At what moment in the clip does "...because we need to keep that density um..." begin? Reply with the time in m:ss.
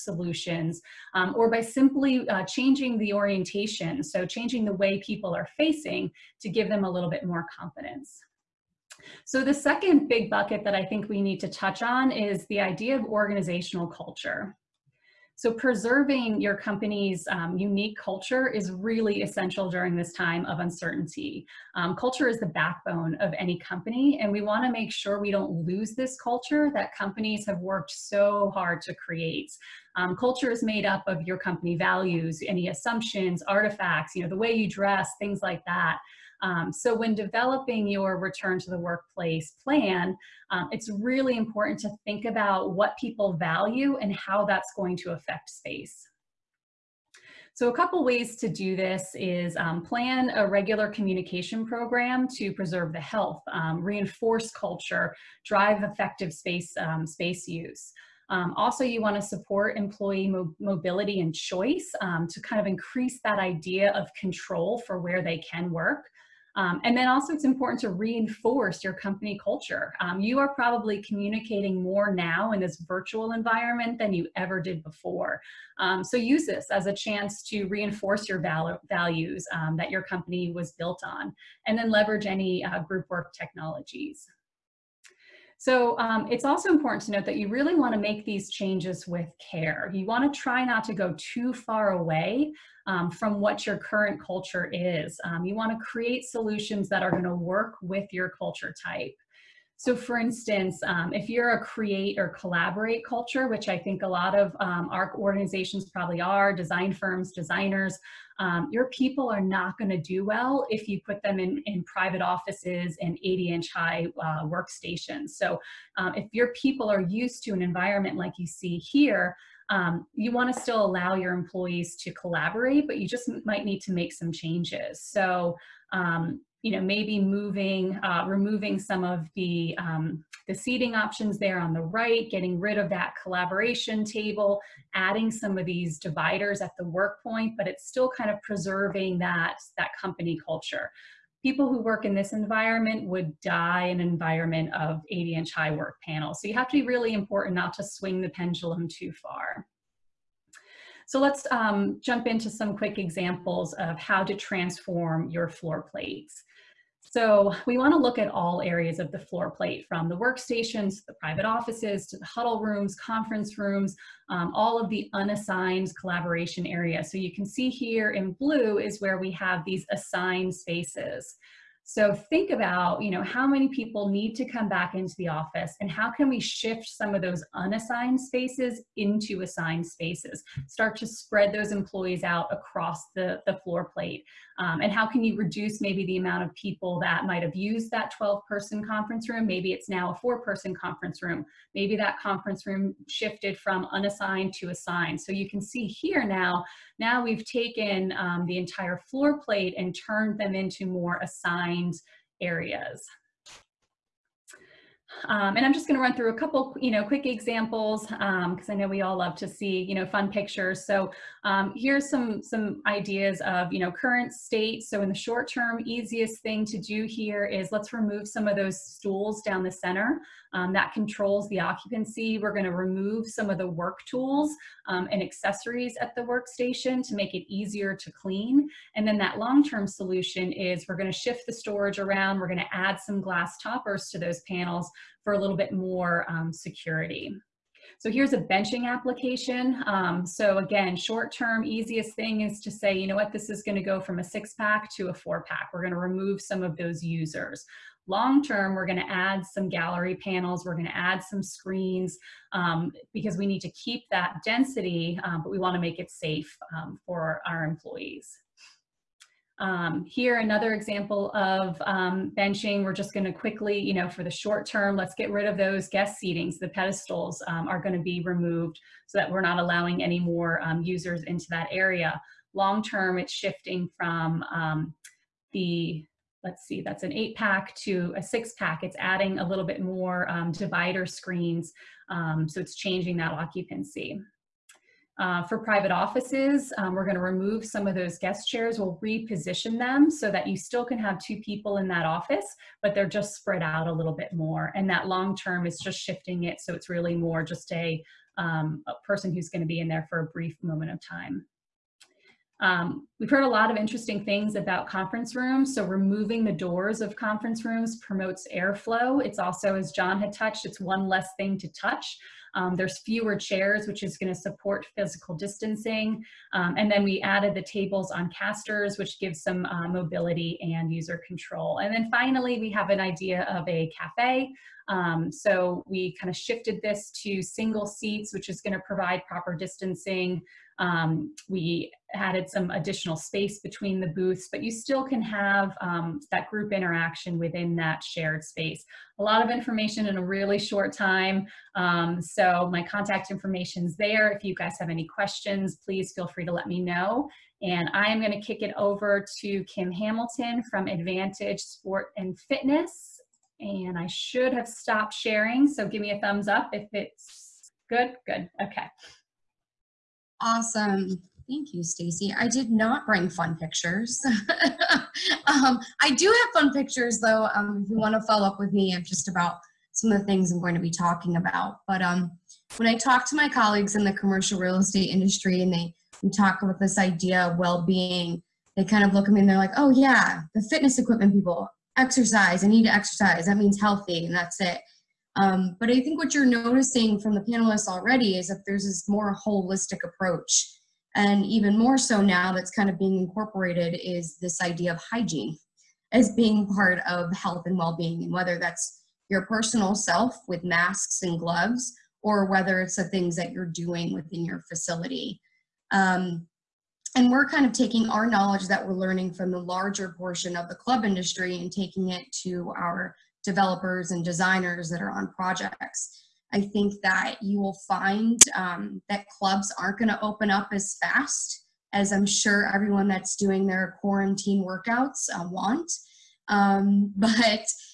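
4:13.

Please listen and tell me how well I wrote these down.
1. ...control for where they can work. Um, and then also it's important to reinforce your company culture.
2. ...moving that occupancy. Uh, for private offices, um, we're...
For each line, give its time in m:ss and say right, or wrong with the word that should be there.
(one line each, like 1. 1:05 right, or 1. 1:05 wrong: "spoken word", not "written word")
1. 1:04 right
2. 4:42 wrong: "changing", not "moving".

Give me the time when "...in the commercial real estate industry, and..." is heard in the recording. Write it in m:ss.
6:13.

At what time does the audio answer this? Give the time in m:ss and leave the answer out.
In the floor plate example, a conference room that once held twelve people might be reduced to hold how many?
3:10.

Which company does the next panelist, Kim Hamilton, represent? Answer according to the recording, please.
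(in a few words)
Advantage Sport and Fitness.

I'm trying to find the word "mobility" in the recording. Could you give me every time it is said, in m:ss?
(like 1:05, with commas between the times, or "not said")
1:00, 5:19.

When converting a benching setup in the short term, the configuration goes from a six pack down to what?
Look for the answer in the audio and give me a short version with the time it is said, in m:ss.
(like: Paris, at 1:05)
four pack, at 4:05.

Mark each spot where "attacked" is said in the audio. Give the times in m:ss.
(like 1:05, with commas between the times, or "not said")
not said.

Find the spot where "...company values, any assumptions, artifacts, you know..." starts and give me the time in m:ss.
0:31.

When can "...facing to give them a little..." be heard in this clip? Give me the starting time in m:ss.
0:05.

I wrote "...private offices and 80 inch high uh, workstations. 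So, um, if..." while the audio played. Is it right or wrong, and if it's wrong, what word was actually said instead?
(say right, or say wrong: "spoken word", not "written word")
right.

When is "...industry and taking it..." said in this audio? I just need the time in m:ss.
6:51.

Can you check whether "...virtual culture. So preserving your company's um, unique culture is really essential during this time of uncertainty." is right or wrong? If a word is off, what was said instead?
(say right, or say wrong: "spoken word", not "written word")
wrong: "organizational", not "virtual".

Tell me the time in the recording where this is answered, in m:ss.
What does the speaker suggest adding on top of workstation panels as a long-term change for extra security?
3:53.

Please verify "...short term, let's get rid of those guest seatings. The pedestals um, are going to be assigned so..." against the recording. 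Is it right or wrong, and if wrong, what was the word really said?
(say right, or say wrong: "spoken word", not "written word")
wrong: "removed", not "assigned".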